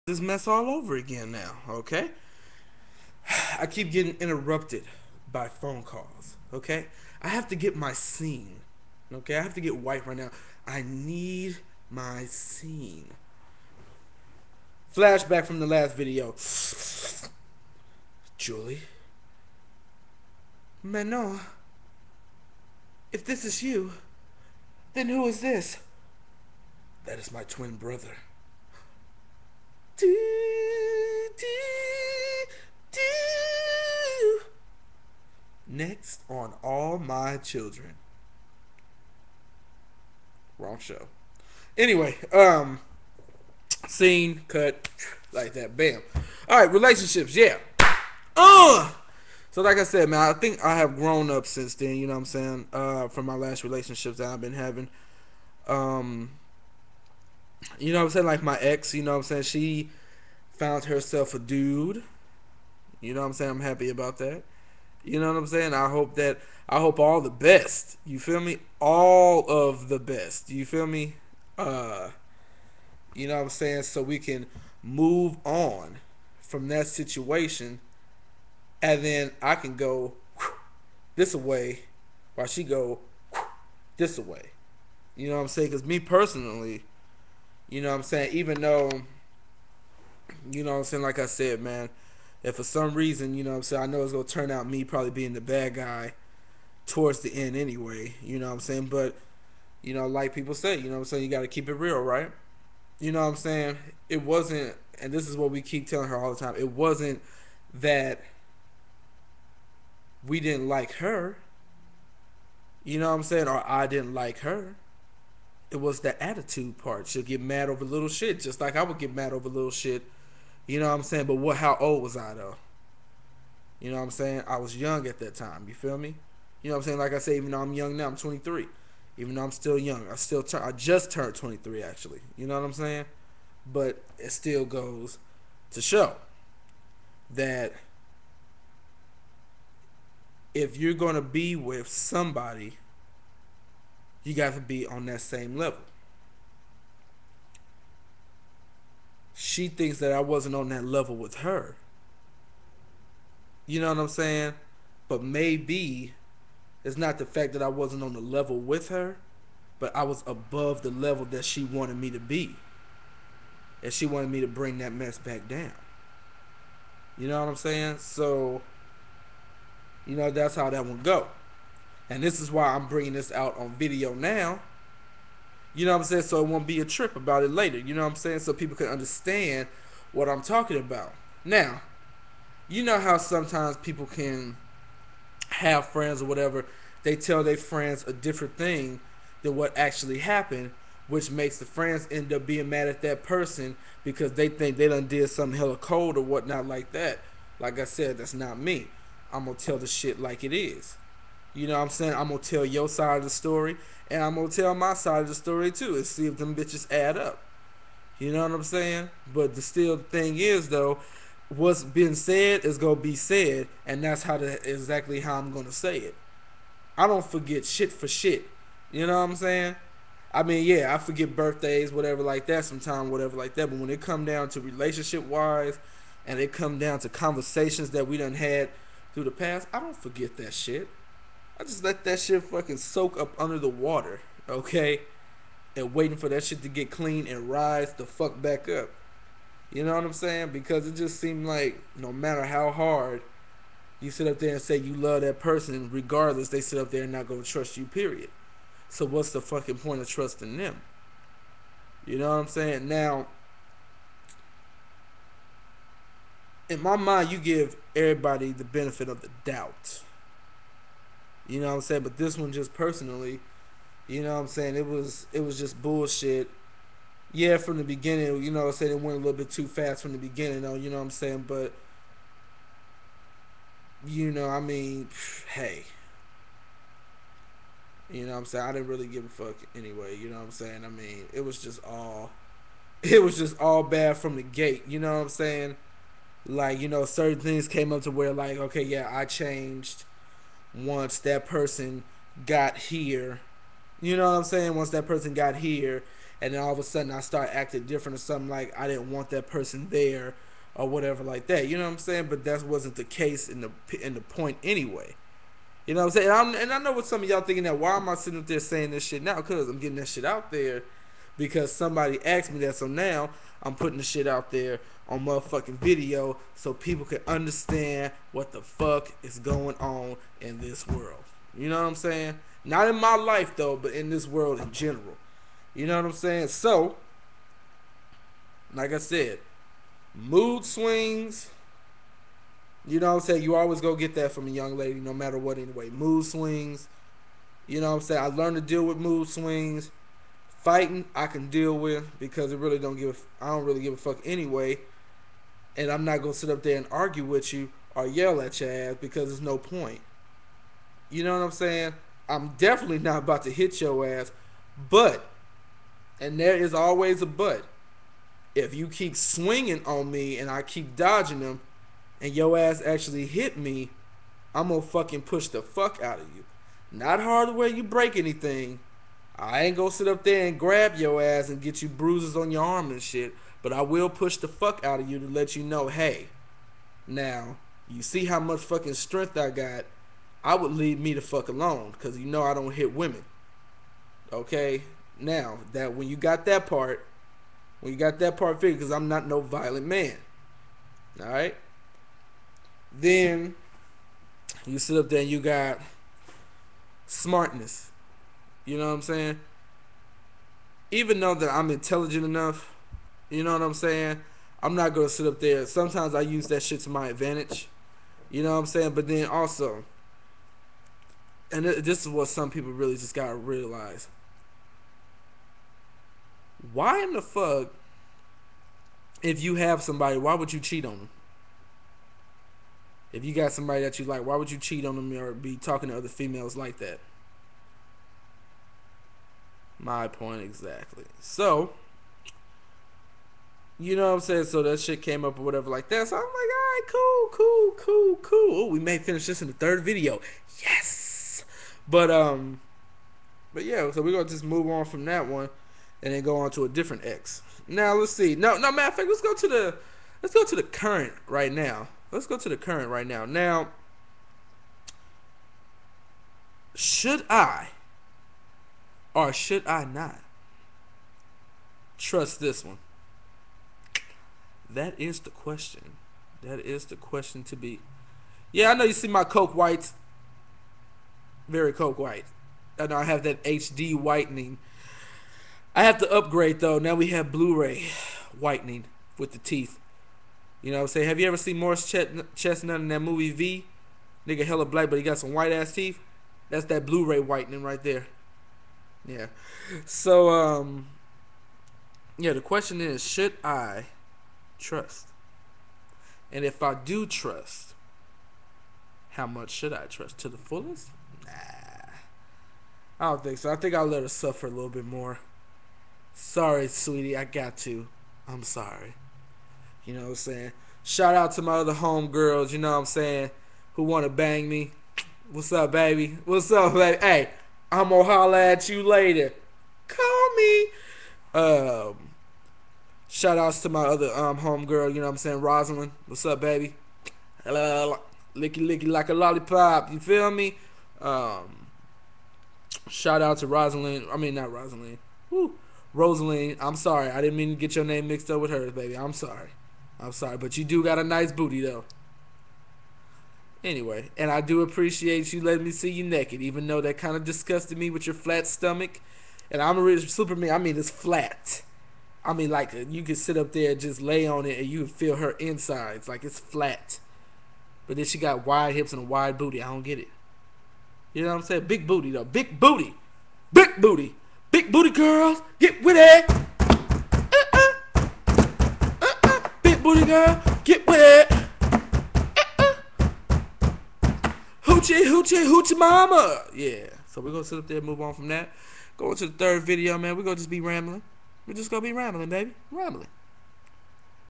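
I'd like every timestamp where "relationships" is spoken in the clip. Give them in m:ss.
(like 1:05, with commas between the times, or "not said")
0:46, 0:53, 3:44.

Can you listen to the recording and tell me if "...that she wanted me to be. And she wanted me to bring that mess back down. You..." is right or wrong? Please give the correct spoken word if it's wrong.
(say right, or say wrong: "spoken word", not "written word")
right.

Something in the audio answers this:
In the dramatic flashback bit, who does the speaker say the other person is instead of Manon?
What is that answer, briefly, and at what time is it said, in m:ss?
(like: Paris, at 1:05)
Twin brother, at 0:27.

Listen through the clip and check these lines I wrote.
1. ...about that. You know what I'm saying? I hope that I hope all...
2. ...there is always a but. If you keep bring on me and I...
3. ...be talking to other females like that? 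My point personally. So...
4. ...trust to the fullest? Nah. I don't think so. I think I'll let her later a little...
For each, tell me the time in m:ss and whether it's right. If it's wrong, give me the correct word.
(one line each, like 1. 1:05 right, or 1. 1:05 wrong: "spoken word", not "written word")
1. 1:03 right
2. 5:56 wrong: "swinging", not "bring"
3. 7:05 wrong: "exactly", not "personally"
4. 8:19 wrong: "suffer", not "later".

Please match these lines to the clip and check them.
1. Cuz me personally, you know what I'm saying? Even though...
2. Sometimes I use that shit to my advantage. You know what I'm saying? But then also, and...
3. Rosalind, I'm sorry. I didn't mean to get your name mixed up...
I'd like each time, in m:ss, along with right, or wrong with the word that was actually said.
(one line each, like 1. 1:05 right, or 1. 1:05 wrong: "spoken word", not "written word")
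1. 1:25 right
2. 6:45 right
3. 8:55 right.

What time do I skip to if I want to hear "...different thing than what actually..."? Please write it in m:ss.
3:08.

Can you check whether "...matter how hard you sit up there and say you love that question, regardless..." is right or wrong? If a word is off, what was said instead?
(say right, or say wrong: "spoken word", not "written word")
wrong: "person", not "question".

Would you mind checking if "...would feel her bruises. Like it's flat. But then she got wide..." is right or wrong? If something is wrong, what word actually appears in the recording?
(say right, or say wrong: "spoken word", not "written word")
wrong: "insides", not "bruises".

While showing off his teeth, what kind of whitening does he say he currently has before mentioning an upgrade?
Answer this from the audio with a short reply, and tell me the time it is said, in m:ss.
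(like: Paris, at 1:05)
HD whitening, at 7:53.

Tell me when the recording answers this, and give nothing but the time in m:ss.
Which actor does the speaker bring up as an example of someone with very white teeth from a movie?
8:01.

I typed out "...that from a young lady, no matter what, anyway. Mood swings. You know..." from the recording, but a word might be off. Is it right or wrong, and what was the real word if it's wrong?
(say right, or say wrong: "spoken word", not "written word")
right.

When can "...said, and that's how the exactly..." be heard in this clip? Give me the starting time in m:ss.
3:33.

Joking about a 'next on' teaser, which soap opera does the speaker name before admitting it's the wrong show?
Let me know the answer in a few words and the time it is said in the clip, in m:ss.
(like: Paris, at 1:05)
All My Children, at 0:36.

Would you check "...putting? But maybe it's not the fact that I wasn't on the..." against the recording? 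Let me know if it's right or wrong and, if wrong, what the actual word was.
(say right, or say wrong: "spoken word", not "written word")
wrong: "saying", not "putting".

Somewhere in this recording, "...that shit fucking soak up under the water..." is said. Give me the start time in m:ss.
3:52.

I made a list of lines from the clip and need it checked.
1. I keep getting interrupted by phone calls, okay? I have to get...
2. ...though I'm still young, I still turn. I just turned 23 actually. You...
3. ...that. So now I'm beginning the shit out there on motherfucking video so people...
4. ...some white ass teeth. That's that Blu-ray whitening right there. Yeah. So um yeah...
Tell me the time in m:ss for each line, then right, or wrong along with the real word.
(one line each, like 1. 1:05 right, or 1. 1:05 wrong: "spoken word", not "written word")
1. 0:03 right
2. 2:09 right
3. 5:12 wrong: "putting", not "beginning"
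4. 8:05 right.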